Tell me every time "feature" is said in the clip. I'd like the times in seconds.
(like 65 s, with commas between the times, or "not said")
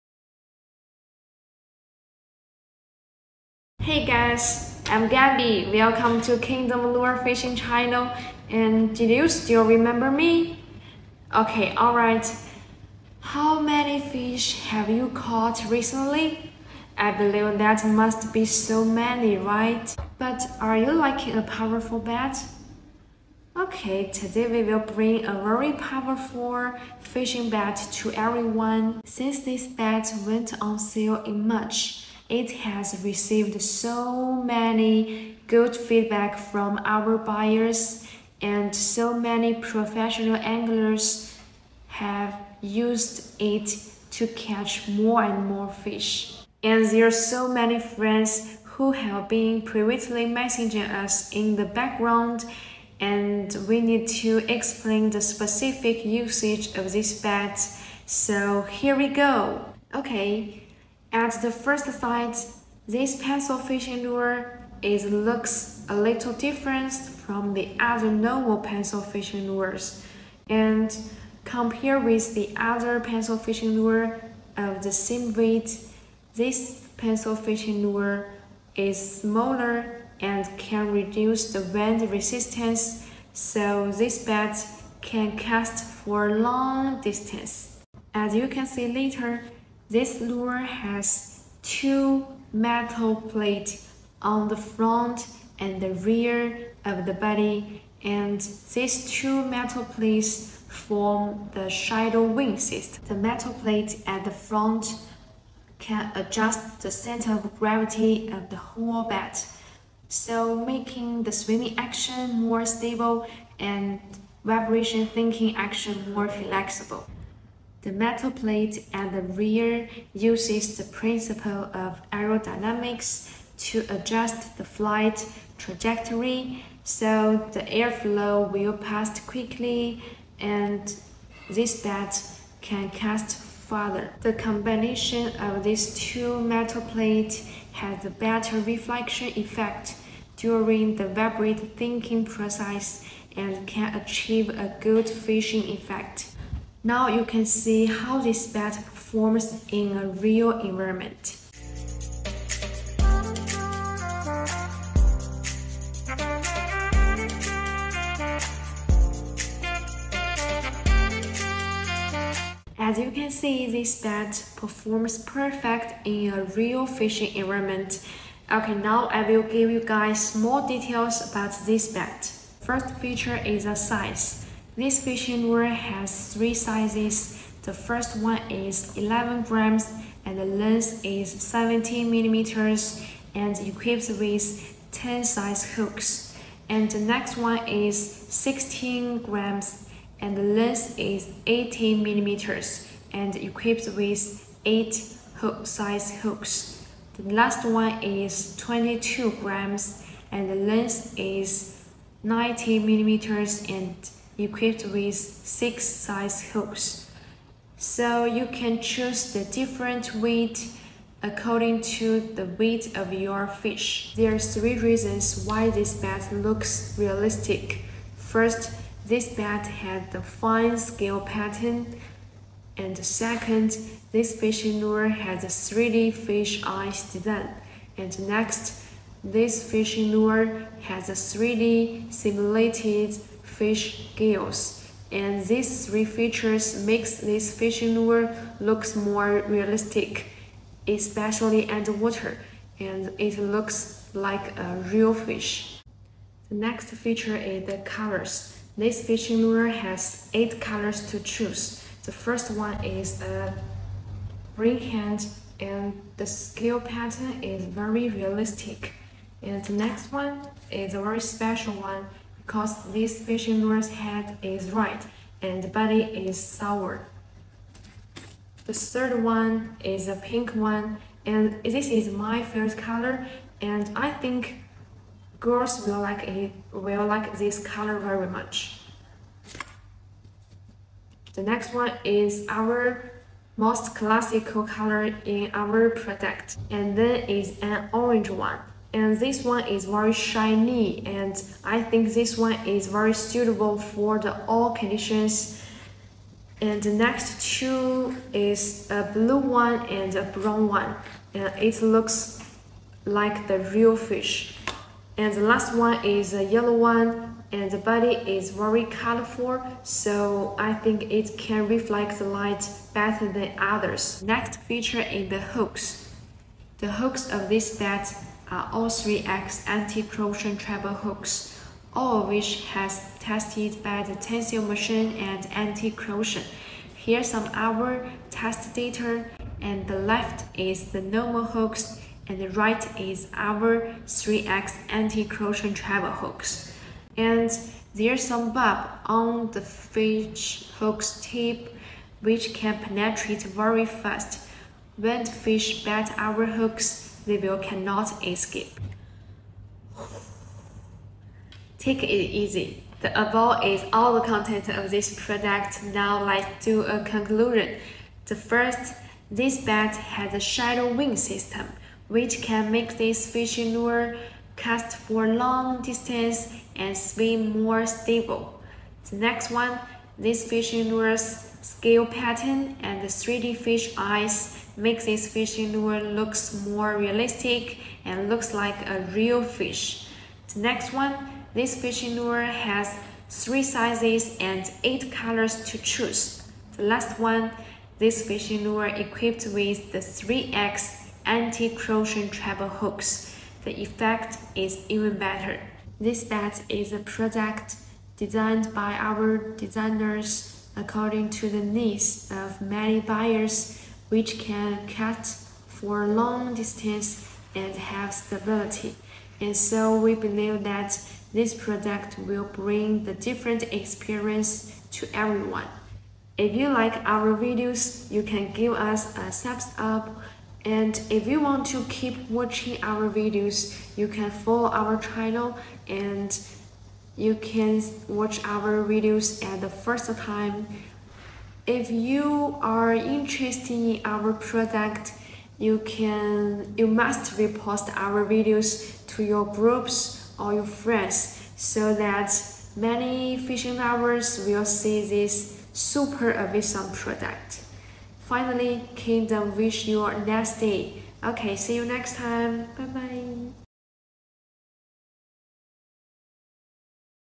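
172 s, 236 s, 247 s, 314 s.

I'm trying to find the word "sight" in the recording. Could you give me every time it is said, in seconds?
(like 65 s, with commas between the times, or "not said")
61 s.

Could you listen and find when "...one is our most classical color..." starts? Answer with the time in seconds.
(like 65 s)
281 s.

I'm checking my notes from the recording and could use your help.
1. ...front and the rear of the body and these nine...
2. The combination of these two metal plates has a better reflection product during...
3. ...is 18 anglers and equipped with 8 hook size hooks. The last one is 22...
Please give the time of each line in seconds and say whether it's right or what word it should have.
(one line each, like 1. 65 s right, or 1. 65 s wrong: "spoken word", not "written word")
1. 94 s wrong: "two", not "nine"
2. 134 s wrong: "effect", not "product"
3. 190 s wrong: "millimeters", not "anglers".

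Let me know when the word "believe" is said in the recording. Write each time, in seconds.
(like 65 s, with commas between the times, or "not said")
17 s, 410 s.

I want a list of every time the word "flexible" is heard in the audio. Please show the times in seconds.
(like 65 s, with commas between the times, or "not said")
116 s.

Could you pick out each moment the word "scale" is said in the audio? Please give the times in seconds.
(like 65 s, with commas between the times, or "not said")
220 s, 256 s, 371 s.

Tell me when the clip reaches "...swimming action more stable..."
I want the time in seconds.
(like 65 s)
111 s.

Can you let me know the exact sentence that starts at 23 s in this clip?
Okay, today we will bring a very powerful fishing bat to everyone since this bat went on sale in March.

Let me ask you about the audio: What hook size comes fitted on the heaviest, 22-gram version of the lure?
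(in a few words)
6.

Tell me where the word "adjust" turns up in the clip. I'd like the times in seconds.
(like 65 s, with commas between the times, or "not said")
106 s, 123 s.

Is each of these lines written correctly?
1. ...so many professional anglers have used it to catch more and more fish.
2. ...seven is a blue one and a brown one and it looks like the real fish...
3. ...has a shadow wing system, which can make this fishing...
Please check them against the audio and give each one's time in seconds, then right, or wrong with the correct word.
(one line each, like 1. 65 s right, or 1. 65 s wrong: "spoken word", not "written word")
1. 38 s right
2. 297 s wrong: "two", not "seven"
3. 359 s right.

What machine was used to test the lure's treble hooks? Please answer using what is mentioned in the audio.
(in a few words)
tensile machine.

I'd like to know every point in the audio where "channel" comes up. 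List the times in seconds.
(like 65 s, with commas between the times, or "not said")
7 s, 424 s.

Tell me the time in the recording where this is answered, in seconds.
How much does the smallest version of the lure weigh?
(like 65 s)
178 s.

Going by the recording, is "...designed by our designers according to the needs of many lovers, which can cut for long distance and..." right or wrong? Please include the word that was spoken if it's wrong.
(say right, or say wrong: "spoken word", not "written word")
wrong: "buyers", not "lovers".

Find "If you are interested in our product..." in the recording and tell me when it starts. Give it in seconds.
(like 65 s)
431 s.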